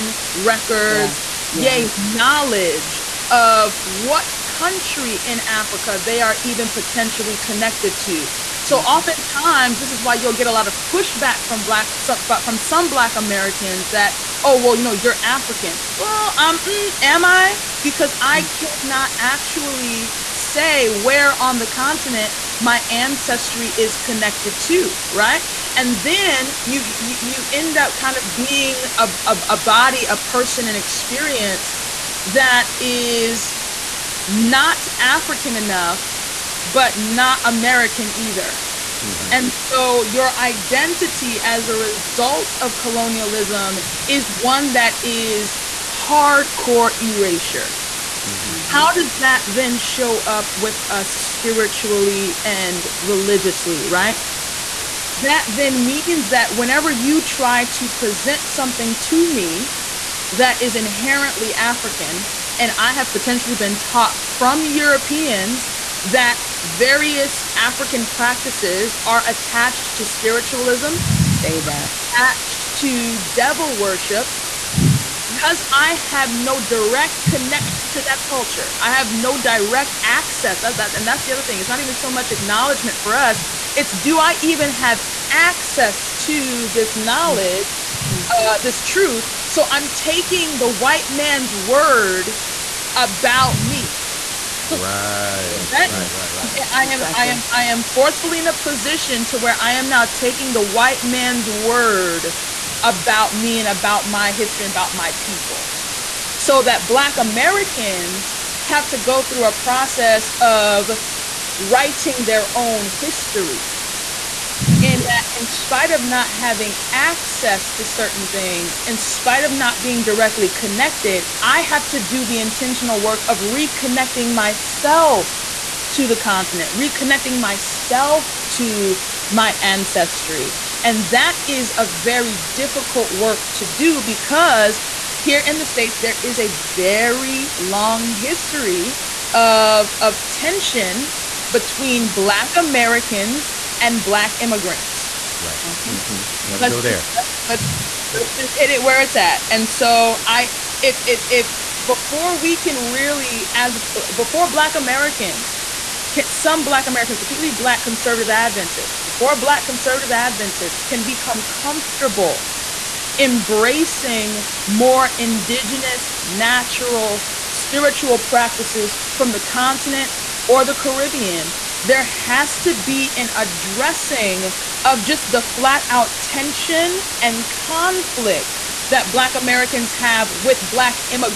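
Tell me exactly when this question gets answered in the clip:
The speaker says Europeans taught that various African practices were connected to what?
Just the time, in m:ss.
1:13.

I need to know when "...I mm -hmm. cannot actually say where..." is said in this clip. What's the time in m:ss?
0:18.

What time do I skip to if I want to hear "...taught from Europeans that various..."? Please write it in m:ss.
1:03.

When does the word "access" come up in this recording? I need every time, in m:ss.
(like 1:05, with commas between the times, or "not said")
1:20, 1:25, 1:56.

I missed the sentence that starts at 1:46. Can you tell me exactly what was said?
So that Black Americans have to go through a process of writing their own history.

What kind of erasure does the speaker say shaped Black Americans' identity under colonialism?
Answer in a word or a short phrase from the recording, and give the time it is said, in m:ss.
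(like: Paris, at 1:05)
hardcore erasure, at 0:45.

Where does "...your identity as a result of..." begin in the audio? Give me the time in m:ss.
0:40.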